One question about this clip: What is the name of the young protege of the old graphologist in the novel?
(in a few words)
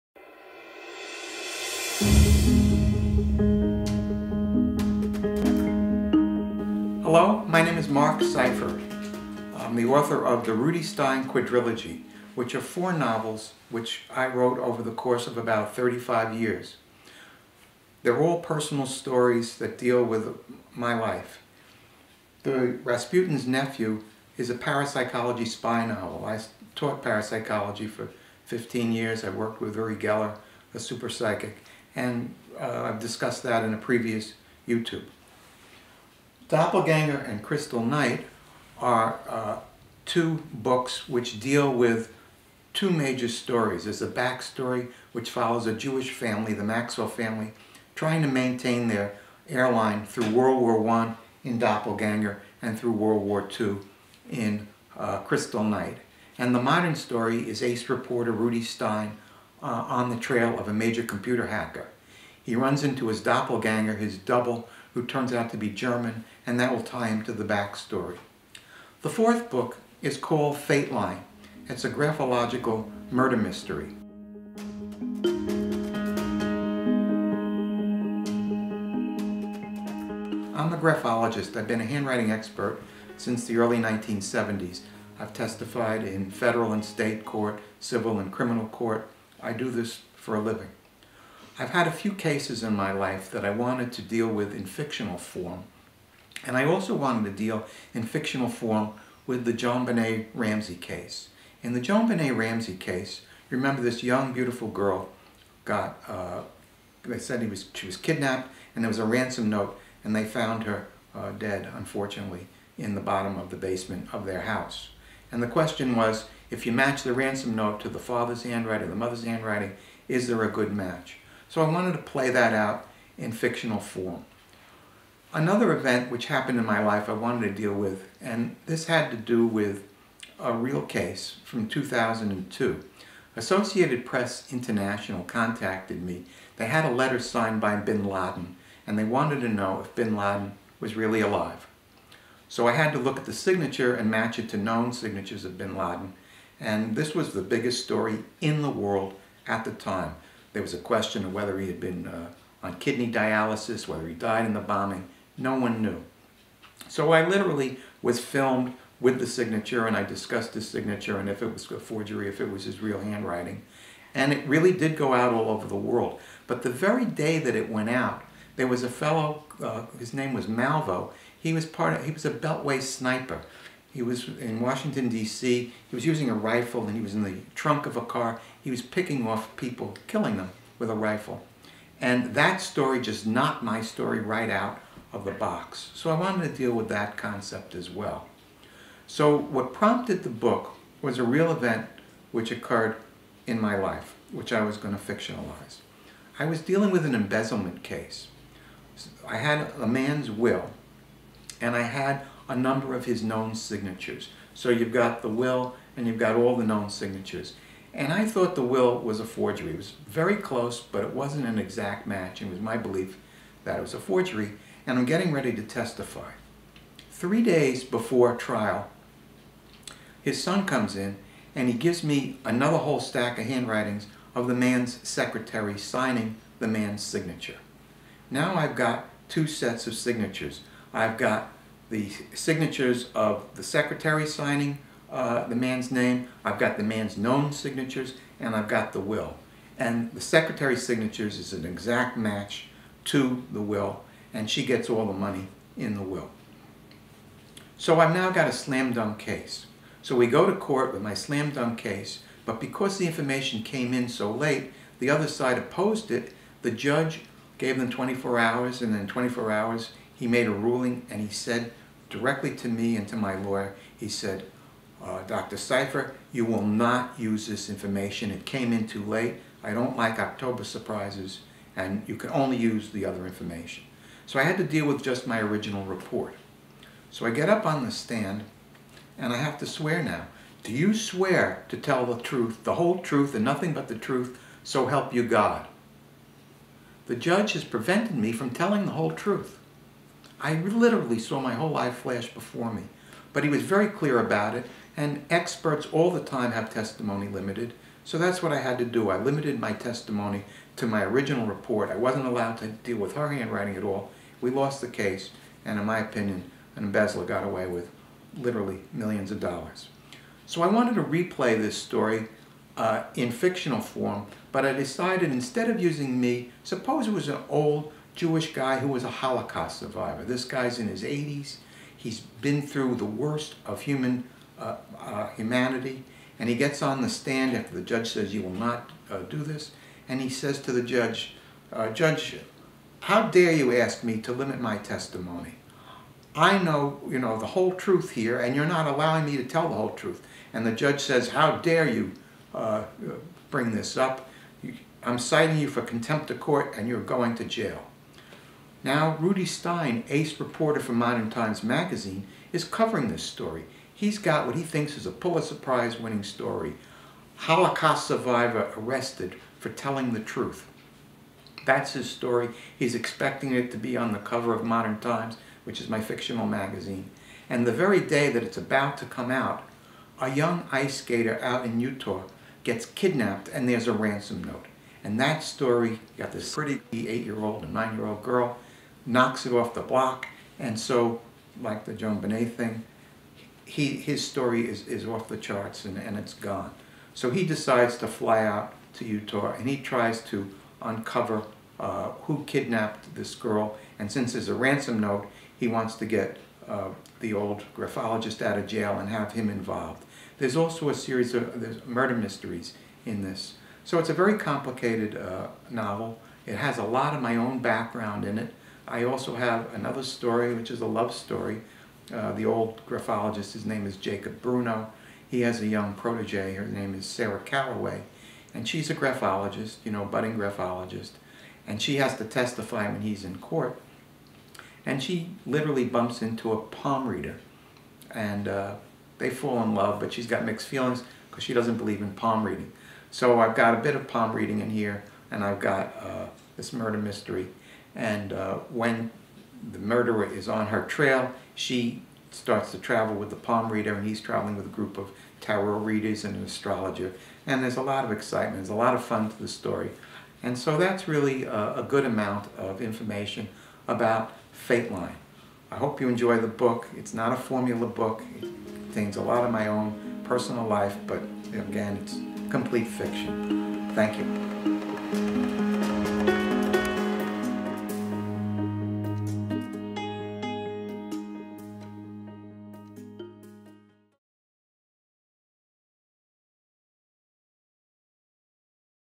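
Sarah Calloway.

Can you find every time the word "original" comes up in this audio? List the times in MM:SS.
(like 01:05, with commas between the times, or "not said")
04:35, 05:01.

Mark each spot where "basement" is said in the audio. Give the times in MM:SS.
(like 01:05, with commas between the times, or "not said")
01:53.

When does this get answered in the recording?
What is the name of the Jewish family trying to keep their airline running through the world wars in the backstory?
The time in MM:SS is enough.
00:46.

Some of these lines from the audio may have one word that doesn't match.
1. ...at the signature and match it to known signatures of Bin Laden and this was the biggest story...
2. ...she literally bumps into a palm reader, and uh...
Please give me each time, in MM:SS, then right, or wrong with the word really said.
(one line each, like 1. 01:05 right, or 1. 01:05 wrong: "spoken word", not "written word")
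1. 02:23 right
2. 07:05 right.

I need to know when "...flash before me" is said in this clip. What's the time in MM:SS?
04:51.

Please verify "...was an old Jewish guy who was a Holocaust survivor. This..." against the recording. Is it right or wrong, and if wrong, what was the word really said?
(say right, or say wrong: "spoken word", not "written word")
right.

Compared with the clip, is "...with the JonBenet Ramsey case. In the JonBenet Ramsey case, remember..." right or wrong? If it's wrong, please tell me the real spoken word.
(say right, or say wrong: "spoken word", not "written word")
right.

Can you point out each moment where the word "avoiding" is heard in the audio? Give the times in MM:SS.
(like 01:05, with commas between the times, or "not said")
not said.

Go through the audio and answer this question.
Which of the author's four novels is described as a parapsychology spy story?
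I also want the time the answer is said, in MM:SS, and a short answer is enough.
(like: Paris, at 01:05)
Rasputin's Nephew, at 00:22.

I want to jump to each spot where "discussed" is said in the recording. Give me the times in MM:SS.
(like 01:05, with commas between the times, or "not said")
00:32, 02:40.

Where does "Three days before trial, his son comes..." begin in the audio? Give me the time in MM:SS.
03:37.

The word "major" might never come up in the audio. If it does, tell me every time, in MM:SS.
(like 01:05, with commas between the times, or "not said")
00:42, 01:00.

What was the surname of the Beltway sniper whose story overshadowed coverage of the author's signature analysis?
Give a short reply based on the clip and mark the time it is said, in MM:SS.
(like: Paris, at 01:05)
Malvo, at 02:50.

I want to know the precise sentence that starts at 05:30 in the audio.
And he says to the judge, uh, Judge, how dare you ask me to limit my testimony?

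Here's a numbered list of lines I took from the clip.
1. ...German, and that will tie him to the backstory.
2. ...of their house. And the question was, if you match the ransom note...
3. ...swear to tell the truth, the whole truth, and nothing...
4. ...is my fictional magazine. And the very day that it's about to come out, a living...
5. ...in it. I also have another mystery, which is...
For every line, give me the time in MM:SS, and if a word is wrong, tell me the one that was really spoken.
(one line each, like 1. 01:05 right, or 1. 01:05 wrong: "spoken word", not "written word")
1. 01:05 right
2. 01:54 right
3. 04:40 right
4. 06:05 wrong: "young", not "living"
5. 06:48 wrong: "story", not "mystery".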